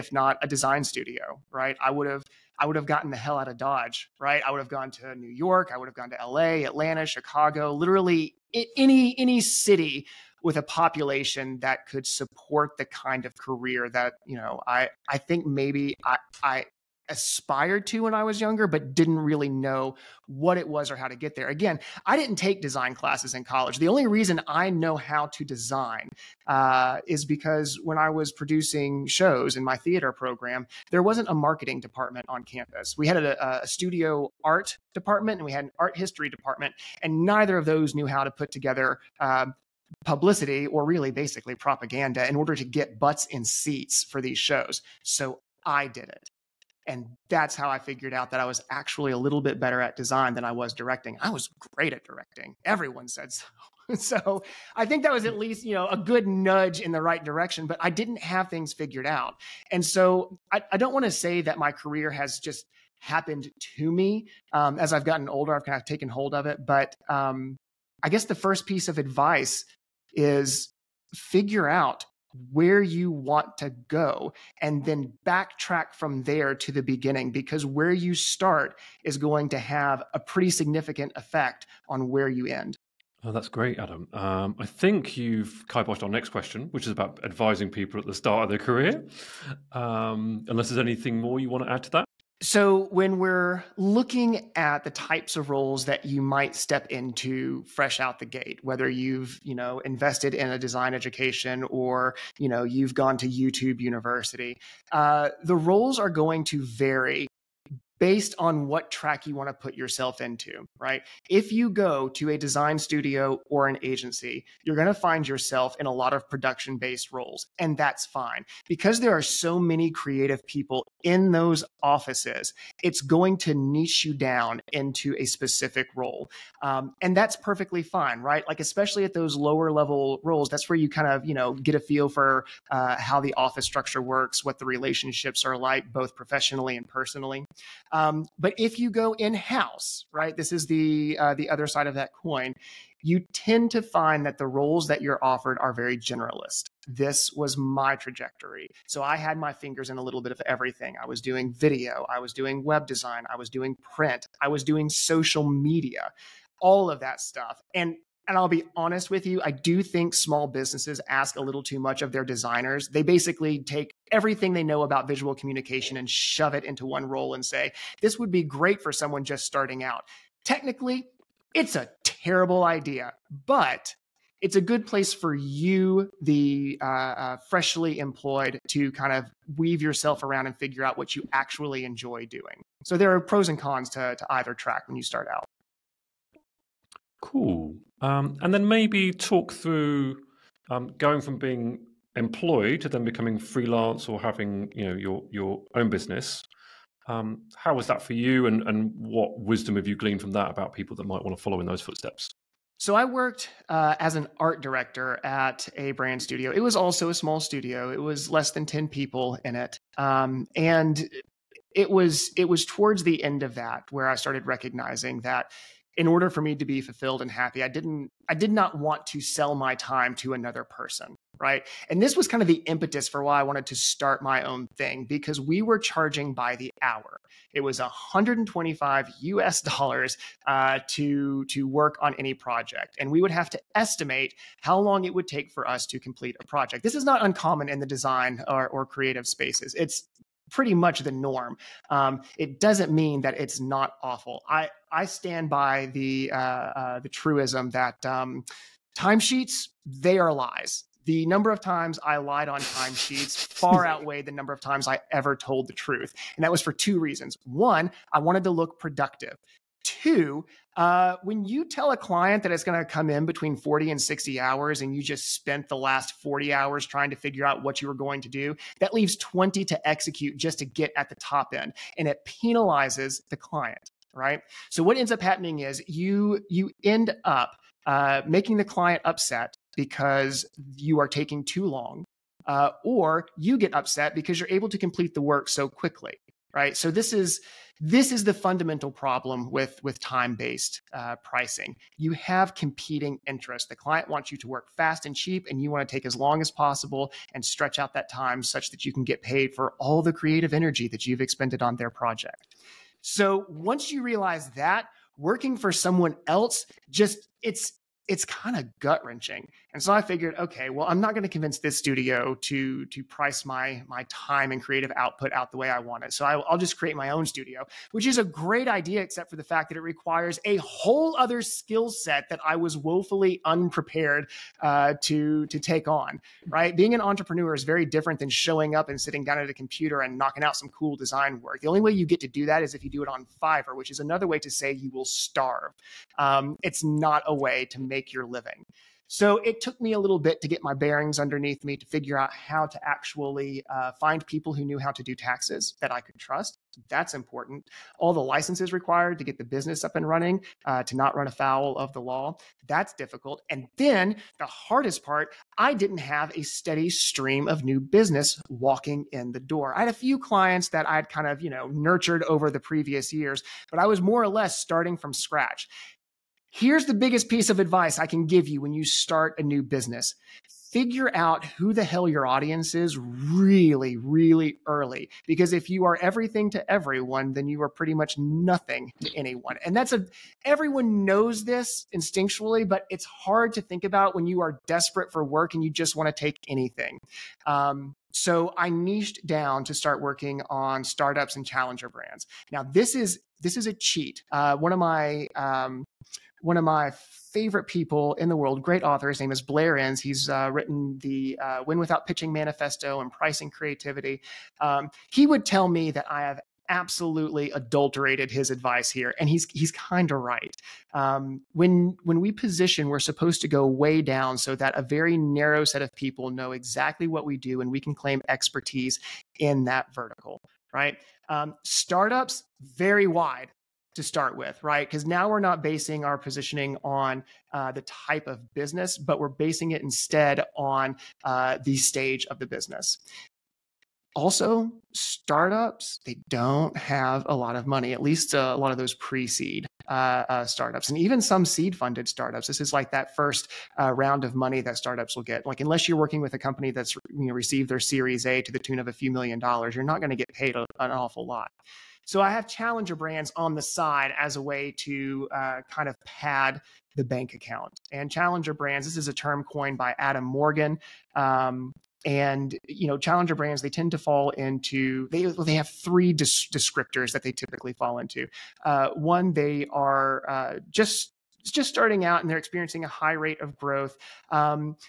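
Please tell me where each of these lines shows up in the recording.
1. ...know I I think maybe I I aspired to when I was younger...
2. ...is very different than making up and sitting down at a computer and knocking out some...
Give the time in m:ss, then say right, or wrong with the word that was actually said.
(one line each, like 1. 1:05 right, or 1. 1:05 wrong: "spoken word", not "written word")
1. 0:14 right
2. 5:27 wrong: "showing", not "making".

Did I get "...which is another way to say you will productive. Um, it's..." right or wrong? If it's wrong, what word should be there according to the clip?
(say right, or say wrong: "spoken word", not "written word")
wrong: "starve", not "productive".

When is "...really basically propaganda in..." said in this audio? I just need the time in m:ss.
0:40.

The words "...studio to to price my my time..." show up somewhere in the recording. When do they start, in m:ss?
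5:11.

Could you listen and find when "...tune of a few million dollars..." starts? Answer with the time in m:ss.
7:28.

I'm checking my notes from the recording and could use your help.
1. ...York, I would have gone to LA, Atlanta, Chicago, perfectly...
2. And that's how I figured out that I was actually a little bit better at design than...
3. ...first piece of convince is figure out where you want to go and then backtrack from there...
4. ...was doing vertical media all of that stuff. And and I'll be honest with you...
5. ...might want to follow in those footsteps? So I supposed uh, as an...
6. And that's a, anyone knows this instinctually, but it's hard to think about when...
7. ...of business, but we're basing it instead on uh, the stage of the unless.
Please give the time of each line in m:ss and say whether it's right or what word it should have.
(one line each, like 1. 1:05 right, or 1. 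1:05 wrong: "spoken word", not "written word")
1. 0:05 wrong: "literally", not "perfectly"
2. 0:46 right
3. 1:08 wrong: "advice", not "convince"
4. 2:34 wrong: "social", not "vertical"
5. 3:21 wrong: "worked", not "supposed"
6. 6:19 wrong: "everyone", not "anyone"
7. 7:08 wrong: "business", not "unless".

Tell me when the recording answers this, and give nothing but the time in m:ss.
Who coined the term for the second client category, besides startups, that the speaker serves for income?
7:39.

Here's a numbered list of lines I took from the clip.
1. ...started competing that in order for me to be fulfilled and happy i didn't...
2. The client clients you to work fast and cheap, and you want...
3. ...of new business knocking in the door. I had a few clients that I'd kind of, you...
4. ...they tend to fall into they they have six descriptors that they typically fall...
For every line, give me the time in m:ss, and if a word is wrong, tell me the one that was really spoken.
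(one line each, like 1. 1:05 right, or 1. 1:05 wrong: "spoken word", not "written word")
1. 3:34 wrong: "recognizing", not "competing"
2. 4:53 wrong: "wants", not "clients"
3. 5:57 wrong: "walking", not "knocking"
4. 7:43 wrong: "three", not "six".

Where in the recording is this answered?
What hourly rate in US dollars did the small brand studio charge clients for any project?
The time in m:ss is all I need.
3:47.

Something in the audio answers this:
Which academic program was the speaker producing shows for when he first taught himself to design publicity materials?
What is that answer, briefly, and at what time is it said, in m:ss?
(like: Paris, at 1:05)
Theater program, at 0:29.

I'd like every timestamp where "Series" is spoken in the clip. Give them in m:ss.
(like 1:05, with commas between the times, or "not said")
7:27.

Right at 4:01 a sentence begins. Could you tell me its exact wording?
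Um, it doesn't mean that it's not awful.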